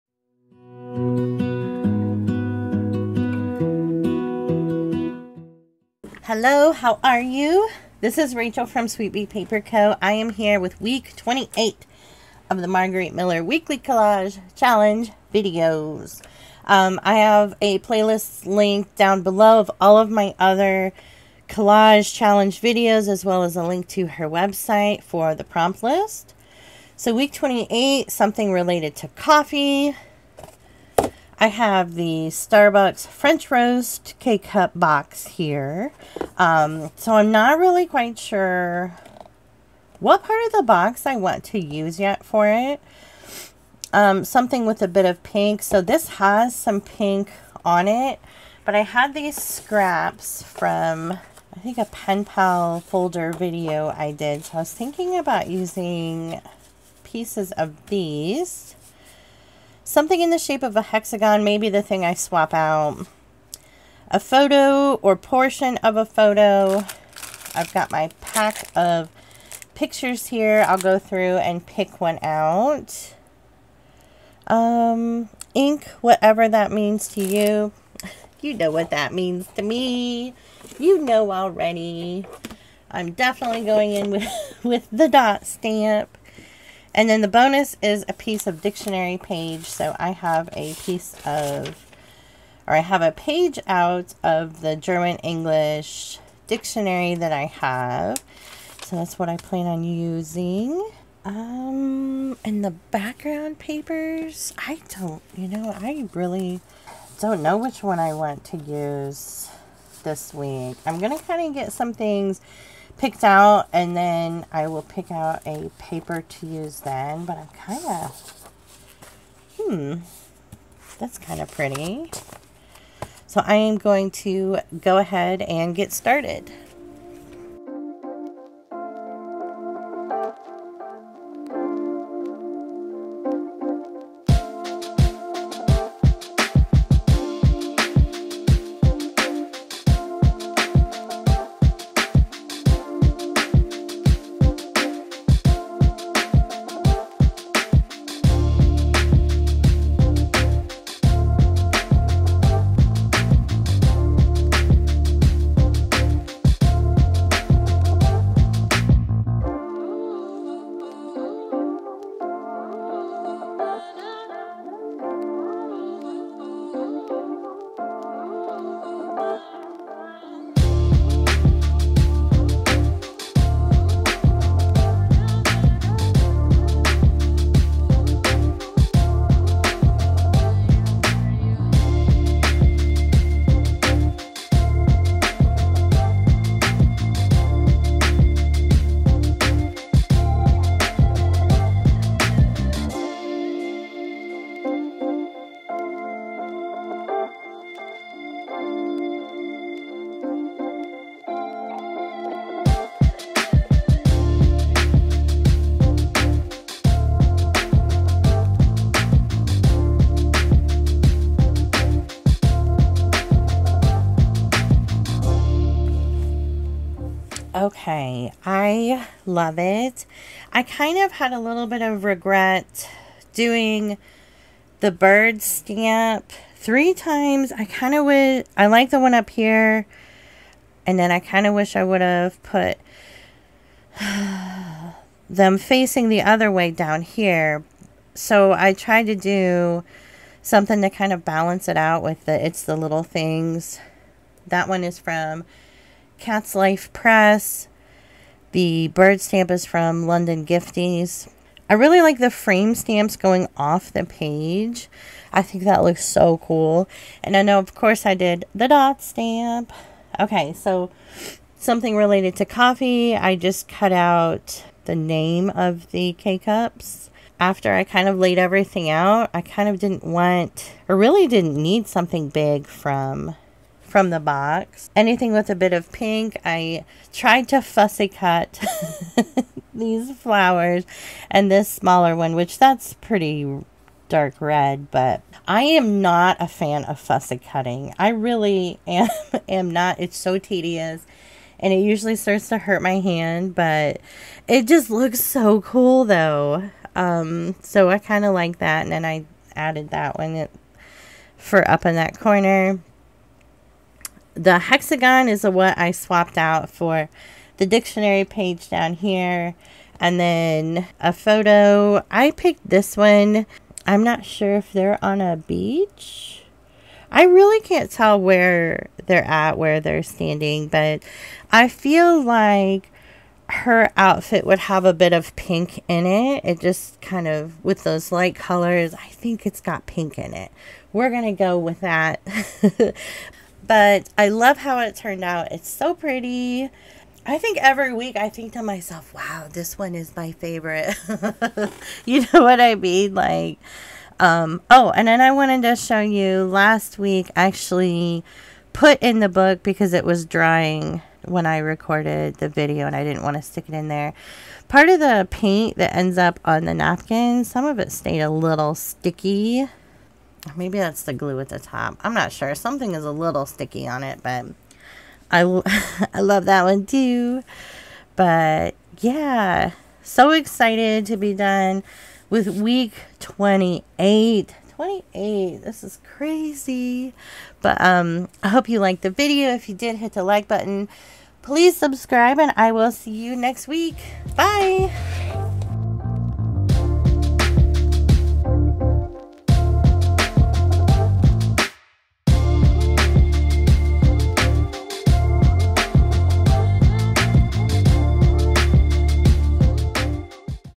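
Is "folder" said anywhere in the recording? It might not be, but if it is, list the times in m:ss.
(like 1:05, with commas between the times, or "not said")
0:52.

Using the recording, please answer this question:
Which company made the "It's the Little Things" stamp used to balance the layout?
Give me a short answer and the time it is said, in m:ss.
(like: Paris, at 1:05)
Catslife Press, at 4:06.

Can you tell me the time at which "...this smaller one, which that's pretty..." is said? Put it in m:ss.
4:41.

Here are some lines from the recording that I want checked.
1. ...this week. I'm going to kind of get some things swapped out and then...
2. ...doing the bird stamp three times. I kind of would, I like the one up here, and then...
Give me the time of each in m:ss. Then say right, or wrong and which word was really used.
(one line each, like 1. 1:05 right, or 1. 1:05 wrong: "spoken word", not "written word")
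1. 1:50 wrong: "picked", not "swapped"
2. 3:43 right.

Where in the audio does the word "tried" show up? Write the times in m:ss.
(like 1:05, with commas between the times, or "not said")
3:58, 4:37.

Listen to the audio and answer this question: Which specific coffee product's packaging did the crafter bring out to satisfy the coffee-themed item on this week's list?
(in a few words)
Starbucks French Roast K-Cup box.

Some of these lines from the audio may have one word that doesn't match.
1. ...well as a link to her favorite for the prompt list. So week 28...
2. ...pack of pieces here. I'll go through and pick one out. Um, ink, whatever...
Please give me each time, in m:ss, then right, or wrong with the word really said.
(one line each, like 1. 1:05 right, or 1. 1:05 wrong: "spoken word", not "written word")
1. 0:23 wrong: "website", not "favorite"
2. 1:08 wrong: "pictures", not "pieces".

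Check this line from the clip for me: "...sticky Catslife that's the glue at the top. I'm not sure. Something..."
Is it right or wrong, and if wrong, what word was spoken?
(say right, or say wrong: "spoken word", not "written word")
wrong: "Maybe", not "Catslife".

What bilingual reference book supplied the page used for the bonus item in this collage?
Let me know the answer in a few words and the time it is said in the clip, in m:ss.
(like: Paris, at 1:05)
German English dictionary, at 1:34.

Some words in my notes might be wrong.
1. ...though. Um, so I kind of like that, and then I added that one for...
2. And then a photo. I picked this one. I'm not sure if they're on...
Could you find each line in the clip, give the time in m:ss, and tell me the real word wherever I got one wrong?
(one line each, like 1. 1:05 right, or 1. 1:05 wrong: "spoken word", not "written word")
1. 4:56 right
2. 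5:09 right.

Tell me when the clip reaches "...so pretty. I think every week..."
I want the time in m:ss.
5:35.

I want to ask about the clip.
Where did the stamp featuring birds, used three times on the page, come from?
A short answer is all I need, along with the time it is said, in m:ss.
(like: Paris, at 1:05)
London Gifties, at 4:10.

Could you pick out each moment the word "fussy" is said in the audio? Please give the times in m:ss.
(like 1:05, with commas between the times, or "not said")
4:37, 4:47.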